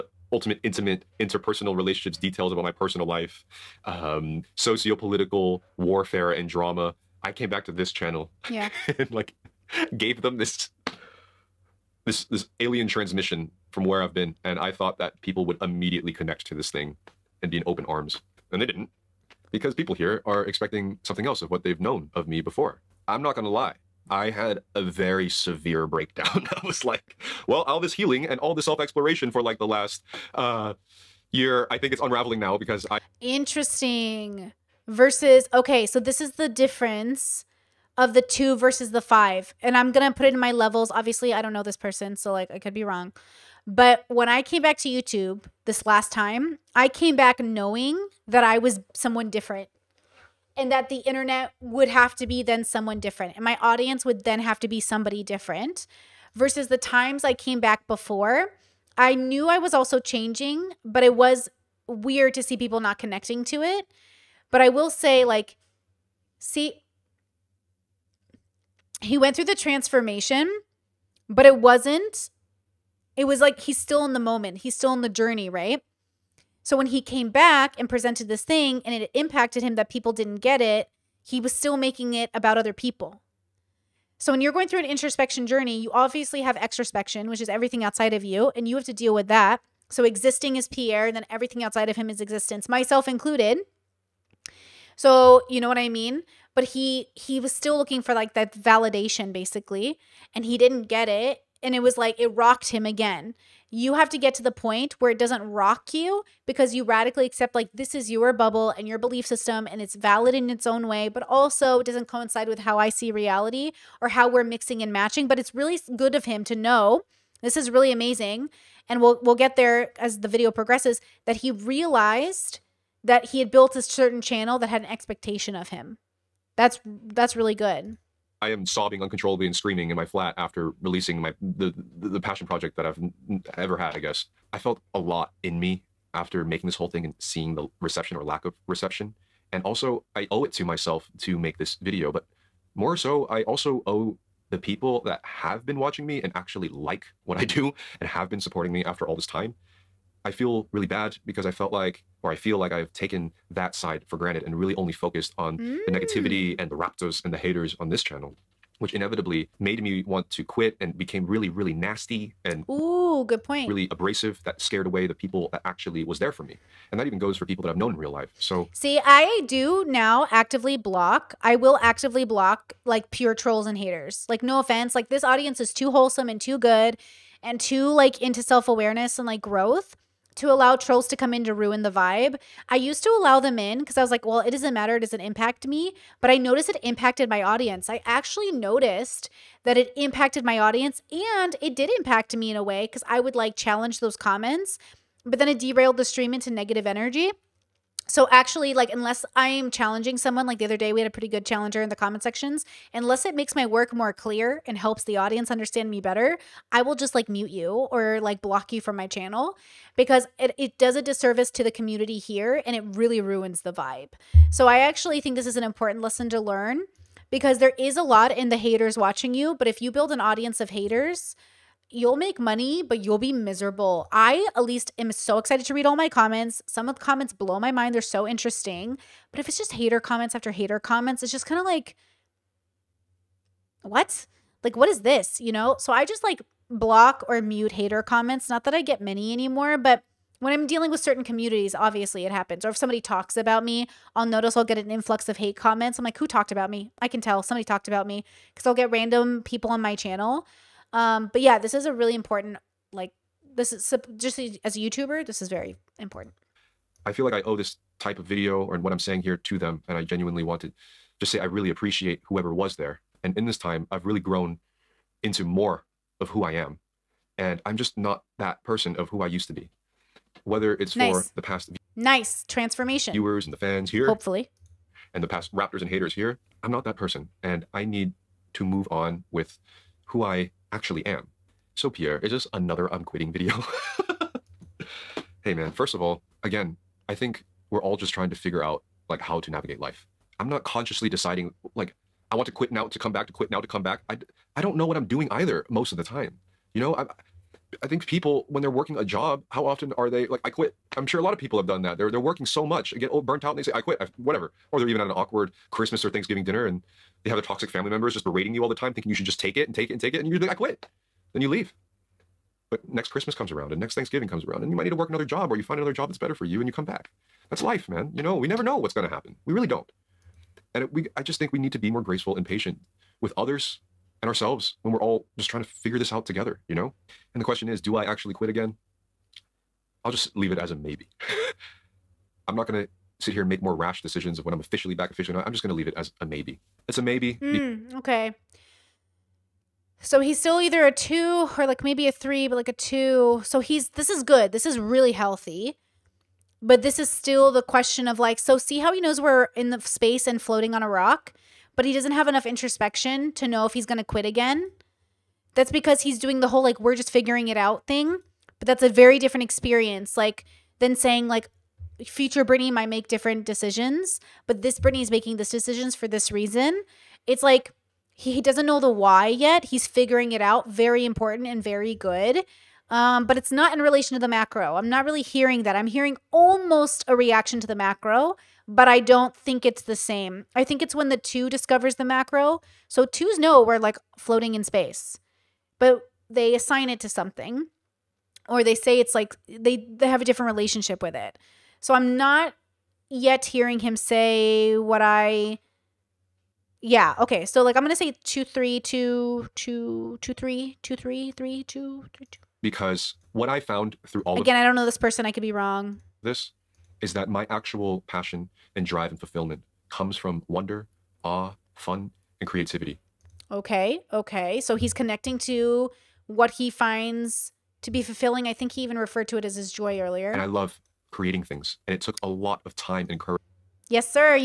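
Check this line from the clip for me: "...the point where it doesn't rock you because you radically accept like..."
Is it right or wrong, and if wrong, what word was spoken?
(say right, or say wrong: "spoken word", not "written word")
right.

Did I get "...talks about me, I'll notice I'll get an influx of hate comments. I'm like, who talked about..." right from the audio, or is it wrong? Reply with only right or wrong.
right.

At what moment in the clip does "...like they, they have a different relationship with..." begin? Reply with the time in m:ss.
6:29.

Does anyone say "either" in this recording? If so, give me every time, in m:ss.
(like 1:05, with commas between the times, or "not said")
4:55, 5:40.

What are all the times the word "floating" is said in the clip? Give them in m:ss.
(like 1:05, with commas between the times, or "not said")
5:50, 6:24.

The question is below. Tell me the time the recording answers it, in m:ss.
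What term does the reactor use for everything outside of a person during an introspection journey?
1:26.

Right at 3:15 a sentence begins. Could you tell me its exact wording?
But then it derailed the stream into negative energy.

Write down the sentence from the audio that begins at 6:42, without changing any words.
Because what I found through all again, of, I don't know this person.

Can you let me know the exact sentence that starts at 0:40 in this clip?
Obviously, I don't know this person, so like I could be wrong.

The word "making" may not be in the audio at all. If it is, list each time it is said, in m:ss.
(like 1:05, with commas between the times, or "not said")
1:21, 2:16, 6:05.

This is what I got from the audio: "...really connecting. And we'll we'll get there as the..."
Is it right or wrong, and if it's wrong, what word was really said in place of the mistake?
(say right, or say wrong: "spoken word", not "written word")
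wrong: "amazing", not "connecting".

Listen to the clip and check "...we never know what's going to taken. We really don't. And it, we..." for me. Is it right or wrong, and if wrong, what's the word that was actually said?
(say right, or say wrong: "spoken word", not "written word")
wrong: "happen", not "taken".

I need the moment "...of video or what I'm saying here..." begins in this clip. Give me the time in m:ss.
4:18.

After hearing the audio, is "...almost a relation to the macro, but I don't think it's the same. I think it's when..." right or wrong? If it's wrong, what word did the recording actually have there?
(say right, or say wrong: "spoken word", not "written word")
wrong: "reaction", not "relation".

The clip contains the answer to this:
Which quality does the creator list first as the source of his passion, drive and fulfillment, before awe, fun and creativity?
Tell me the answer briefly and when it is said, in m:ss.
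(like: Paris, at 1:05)
wonder, at 6:50.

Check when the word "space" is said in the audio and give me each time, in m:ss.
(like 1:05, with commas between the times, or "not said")
5:49, 6:24.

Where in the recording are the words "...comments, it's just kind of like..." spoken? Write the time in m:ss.
3:50.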